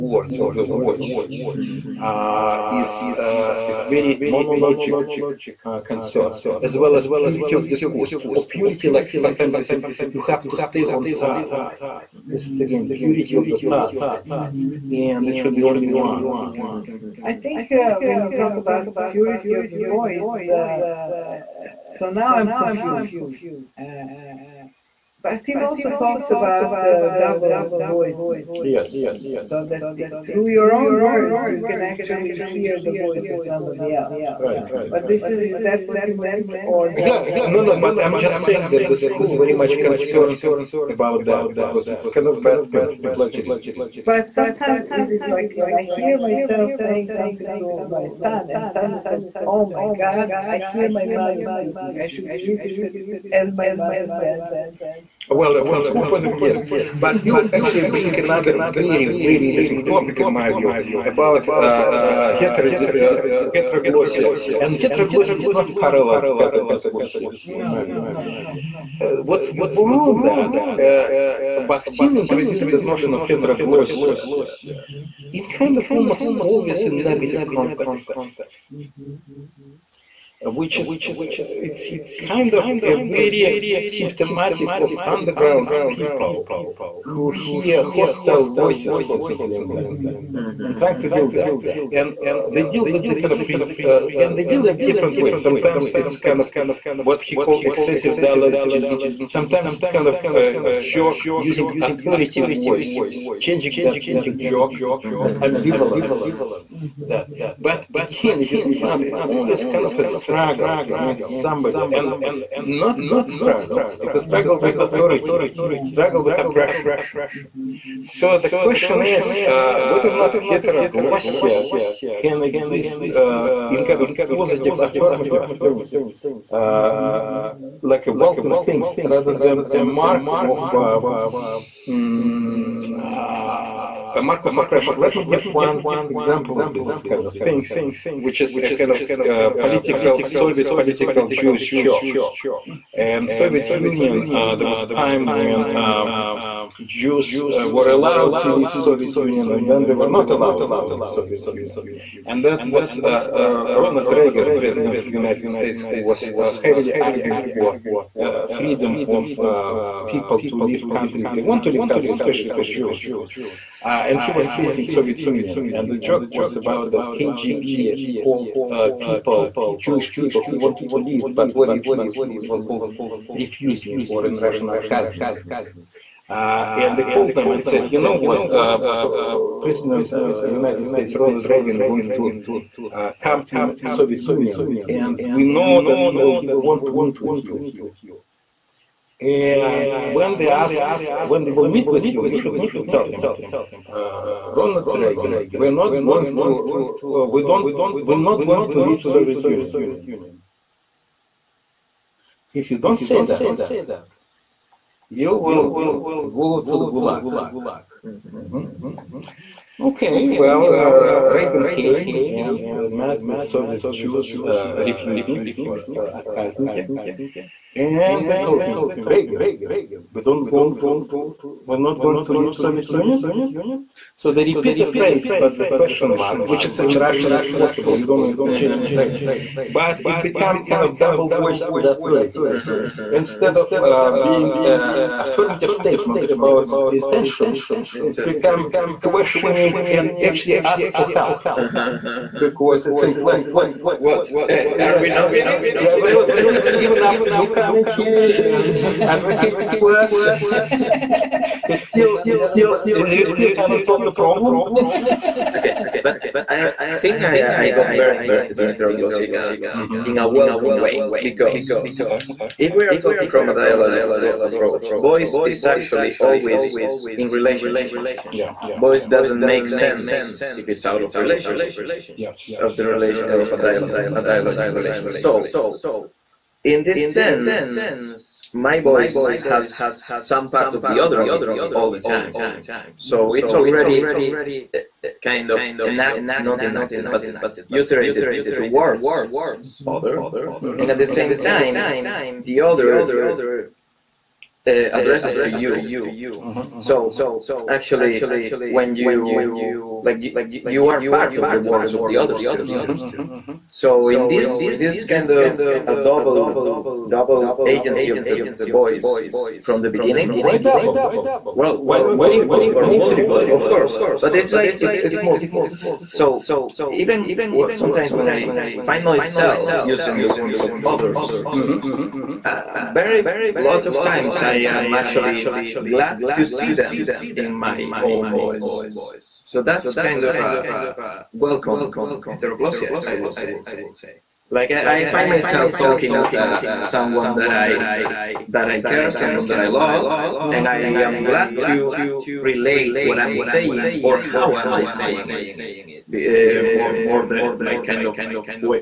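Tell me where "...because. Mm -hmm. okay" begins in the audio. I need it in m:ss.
4:21.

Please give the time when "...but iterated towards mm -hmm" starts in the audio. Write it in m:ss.
4:47.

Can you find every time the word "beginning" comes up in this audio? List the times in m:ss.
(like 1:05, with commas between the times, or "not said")
5:09.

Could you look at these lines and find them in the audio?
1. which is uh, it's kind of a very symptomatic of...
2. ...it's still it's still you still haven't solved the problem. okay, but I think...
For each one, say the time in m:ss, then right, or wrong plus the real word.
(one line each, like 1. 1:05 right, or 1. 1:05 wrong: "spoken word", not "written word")
1. 1:20 right
2. 4:11 right.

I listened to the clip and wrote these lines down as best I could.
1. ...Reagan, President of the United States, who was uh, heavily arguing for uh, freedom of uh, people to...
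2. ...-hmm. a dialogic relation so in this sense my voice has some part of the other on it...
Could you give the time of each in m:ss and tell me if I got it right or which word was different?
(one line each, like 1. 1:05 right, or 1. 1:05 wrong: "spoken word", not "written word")
1. 2:34 right
2. 4:33 right.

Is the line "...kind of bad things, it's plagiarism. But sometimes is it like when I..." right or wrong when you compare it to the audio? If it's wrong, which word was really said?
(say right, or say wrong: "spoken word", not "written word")
right.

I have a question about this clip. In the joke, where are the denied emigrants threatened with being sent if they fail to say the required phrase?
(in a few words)
the Gulag.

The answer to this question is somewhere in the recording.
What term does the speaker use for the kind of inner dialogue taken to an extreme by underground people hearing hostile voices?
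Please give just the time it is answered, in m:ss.
1:37.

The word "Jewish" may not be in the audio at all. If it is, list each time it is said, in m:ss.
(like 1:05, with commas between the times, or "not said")
2:21, 2:49.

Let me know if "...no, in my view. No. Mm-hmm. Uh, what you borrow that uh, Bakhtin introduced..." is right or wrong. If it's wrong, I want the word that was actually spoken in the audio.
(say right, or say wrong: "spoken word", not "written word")
right.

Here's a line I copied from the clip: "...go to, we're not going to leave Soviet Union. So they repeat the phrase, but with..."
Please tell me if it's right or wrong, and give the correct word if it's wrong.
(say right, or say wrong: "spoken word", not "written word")
right.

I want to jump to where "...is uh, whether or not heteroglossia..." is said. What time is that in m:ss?
1:59.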